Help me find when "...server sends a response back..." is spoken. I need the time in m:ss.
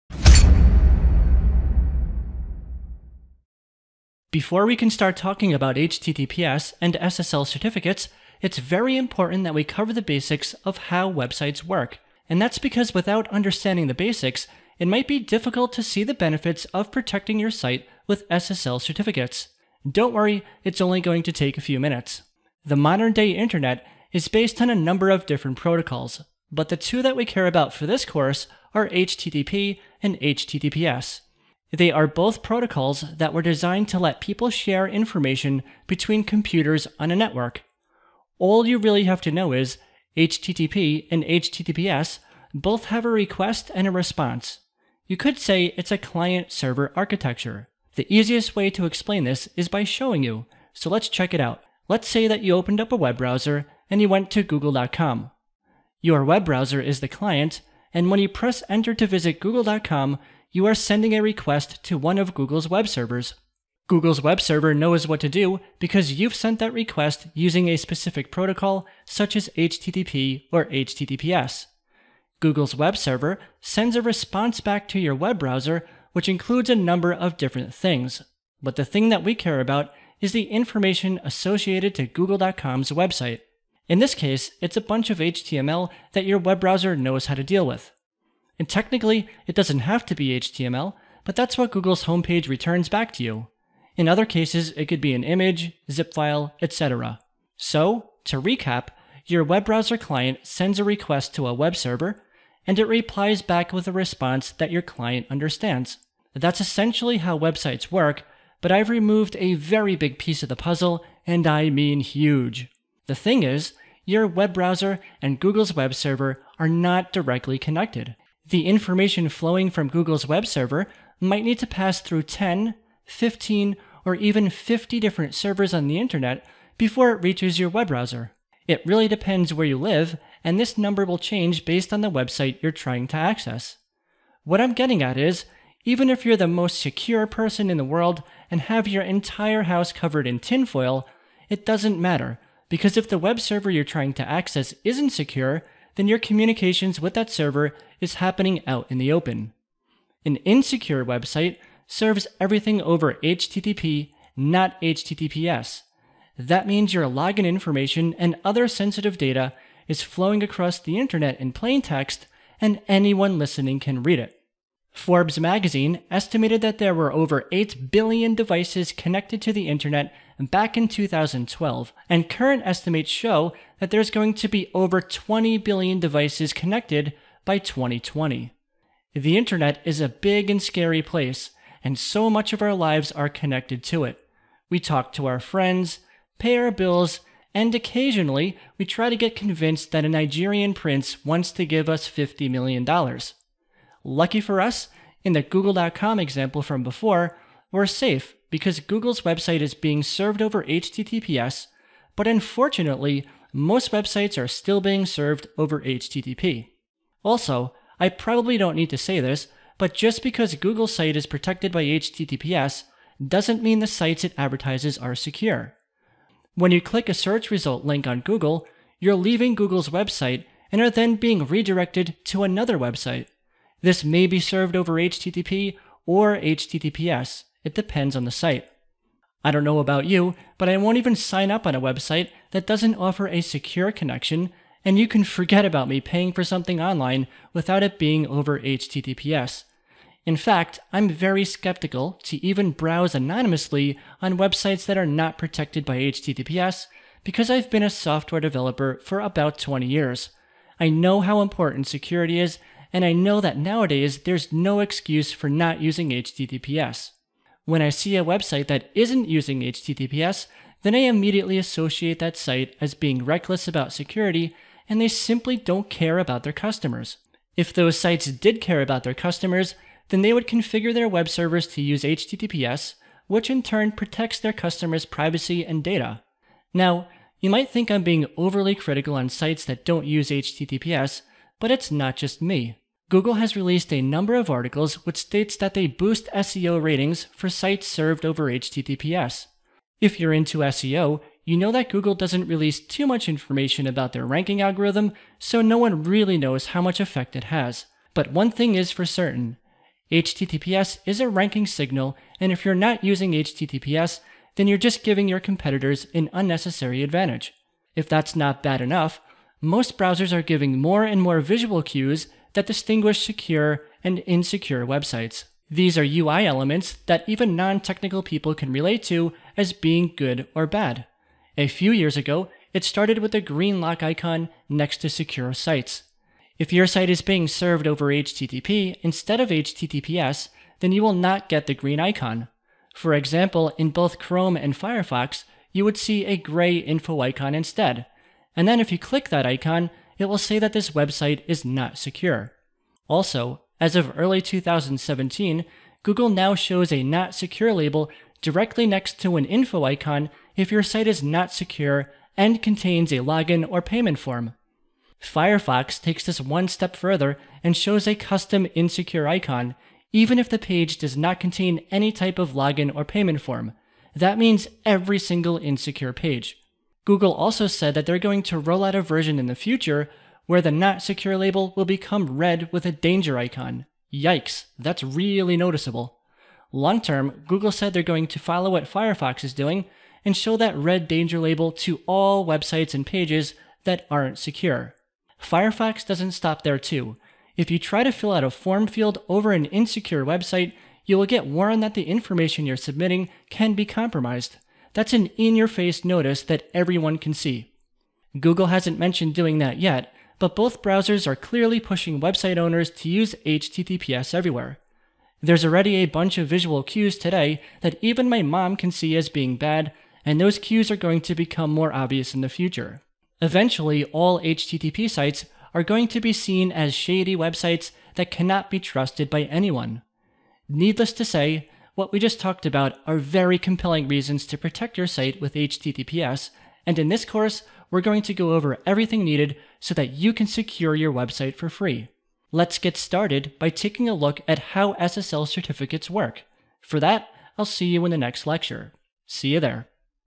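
1:12.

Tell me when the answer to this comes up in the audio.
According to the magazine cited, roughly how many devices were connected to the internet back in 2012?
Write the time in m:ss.
2:47.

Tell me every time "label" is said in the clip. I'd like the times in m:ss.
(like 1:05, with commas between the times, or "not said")
5:47, 6:11, 6:21.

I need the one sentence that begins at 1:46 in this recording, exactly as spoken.
That's essentially how websites work, but I've removed a very big piece of the puzzle, and I mean huge.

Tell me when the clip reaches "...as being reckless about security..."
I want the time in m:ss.
4:22.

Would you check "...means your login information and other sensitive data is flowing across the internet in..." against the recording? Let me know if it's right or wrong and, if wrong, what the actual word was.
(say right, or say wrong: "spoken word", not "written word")
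right.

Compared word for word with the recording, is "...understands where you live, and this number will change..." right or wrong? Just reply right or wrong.
wrong.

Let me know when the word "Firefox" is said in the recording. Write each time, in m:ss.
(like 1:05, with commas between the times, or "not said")
5:34, 5:55, 6:18, 6:25.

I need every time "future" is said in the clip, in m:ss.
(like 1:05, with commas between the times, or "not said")
6:09, 6:52.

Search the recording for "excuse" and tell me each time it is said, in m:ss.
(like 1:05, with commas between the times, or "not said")
4:14.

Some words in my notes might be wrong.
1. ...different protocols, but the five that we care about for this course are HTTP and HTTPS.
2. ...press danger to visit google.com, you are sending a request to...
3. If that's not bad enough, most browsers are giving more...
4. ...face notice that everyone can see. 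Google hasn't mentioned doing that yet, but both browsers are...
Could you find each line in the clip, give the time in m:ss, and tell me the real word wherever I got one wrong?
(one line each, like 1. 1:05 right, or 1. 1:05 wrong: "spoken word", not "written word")
1. 0:25 wrong: "two", not "five"
2. 0:58 wrong: "enter", not "danger"
3. 5:07 right
4. 6:35 right.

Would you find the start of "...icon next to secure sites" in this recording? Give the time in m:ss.
5:24.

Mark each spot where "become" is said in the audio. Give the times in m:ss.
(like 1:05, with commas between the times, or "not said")
6:11, 6:51.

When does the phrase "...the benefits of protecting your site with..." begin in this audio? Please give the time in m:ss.
0:16.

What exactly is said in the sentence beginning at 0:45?
You could say it's a client server architecture.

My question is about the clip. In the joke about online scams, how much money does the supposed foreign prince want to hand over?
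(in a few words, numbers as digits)
$50 million.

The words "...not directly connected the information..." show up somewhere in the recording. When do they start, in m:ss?
1:56.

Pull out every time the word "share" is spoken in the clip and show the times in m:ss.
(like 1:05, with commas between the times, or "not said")
0:34.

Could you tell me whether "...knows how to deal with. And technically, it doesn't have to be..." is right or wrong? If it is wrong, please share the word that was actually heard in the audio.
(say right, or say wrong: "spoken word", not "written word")
right.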